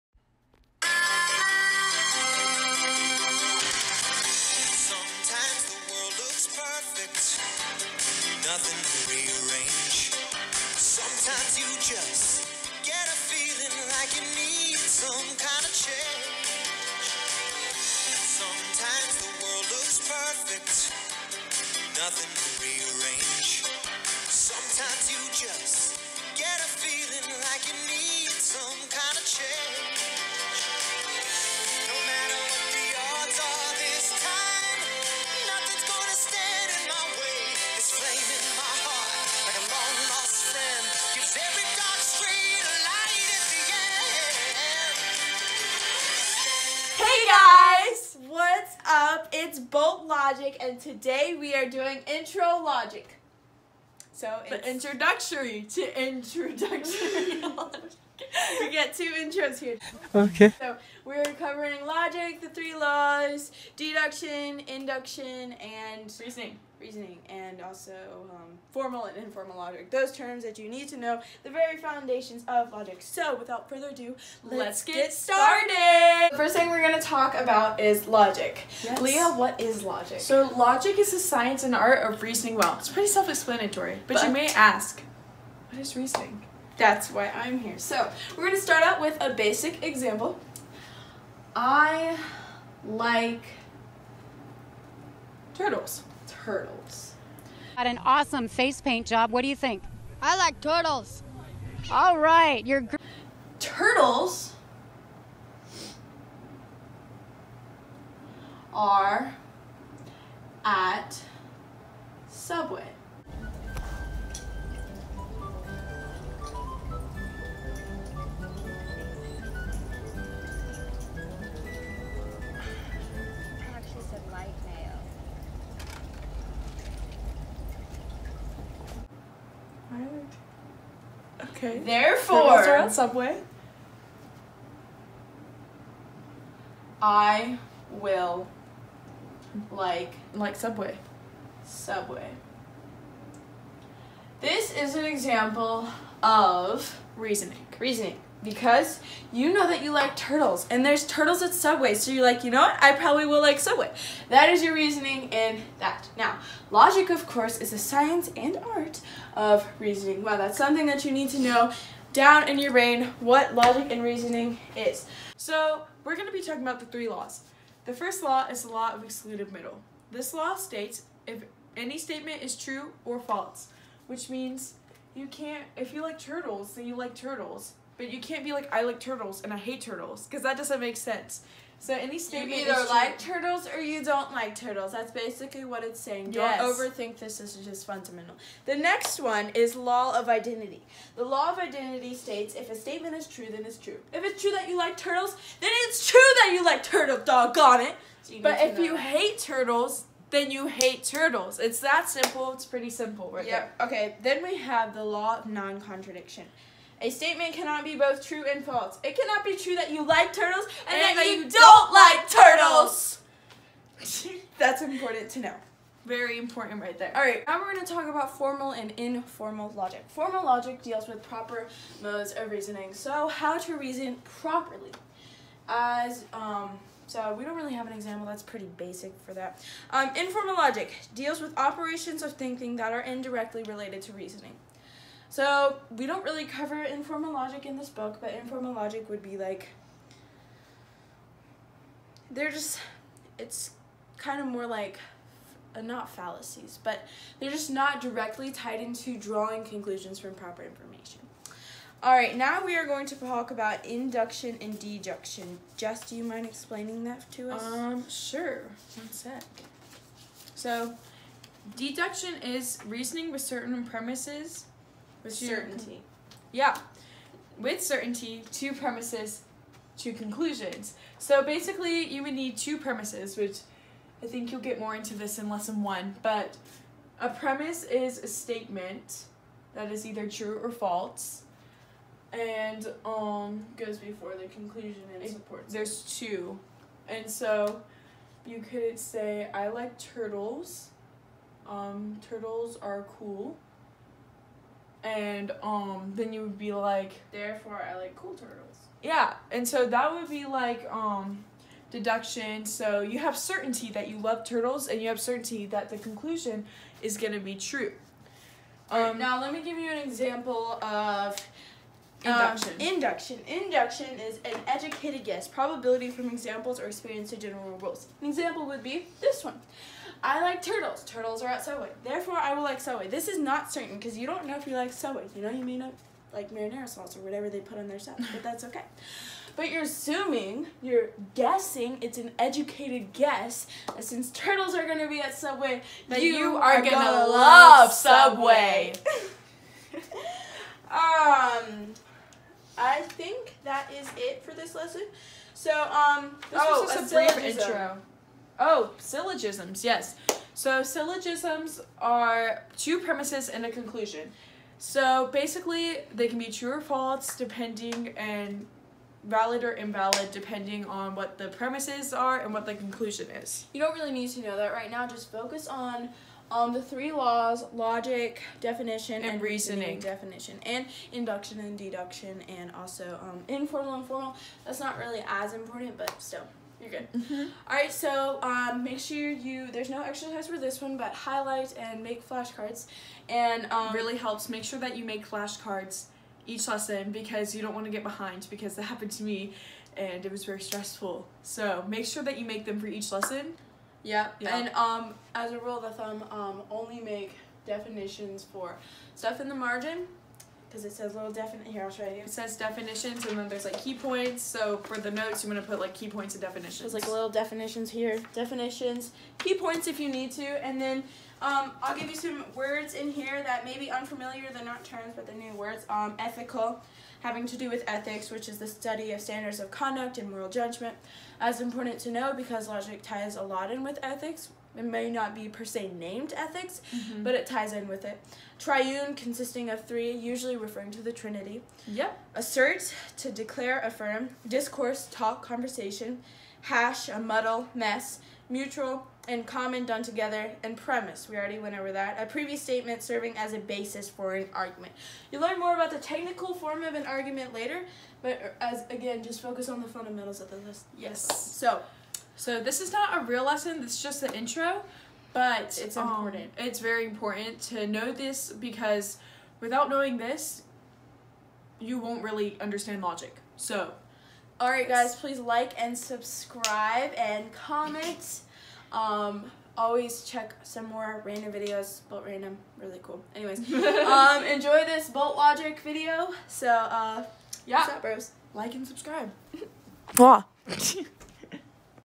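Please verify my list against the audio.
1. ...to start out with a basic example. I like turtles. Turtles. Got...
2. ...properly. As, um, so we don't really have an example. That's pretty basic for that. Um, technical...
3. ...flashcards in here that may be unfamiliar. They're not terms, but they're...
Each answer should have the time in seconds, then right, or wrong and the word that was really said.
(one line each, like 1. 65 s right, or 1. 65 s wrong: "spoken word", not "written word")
1. 88 s right
2. 224 s wrong: "informal", not "technical"
3. 412 s wrong: "words", not "flashcards".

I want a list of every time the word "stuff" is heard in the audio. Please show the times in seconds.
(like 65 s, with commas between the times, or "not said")
327 s, 399 s.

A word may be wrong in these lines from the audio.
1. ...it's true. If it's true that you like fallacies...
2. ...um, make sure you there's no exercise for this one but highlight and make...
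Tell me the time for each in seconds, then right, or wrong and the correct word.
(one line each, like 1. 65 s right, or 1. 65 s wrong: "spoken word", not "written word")
1. 193 s wrong: "turtles", not "fallacies"
2. 378 s right.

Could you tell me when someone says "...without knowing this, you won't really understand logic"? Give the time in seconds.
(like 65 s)
459 s.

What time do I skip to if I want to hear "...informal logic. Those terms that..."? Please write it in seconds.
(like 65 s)
69 s.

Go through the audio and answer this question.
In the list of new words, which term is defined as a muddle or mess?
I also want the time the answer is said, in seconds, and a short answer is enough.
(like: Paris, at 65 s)
Hash, at 436 s.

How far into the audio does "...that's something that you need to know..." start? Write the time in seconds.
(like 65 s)
160 s.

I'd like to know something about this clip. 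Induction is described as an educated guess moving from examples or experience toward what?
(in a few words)
General rules.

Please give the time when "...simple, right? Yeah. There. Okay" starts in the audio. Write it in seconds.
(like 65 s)
202 s.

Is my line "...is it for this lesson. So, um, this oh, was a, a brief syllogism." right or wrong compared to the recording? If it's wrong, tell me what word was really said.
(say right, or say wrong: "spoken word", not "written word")
right.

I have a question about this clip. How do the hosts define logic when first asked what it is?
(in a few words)
The science and art of reasoning well.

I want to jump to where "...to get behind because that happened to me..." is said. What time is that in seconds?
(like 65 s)
387 s.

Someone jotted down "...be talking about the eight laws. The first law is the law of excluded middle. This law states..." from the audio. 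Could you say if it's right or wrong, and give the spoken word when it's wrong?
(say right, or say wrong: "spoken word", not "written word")
wrong: "three", not "eight".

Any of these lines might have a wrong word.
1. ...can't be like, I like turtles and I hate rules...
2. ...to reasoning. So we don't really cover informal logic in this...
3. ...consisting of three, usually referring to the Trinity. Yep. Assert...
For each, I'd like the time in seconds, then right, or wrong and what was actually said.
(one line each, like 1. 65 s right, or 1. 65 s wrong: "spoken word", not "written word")
1. 178 s wrong: "turtles", not "rules"
2. 234 s right
3. 429 s right.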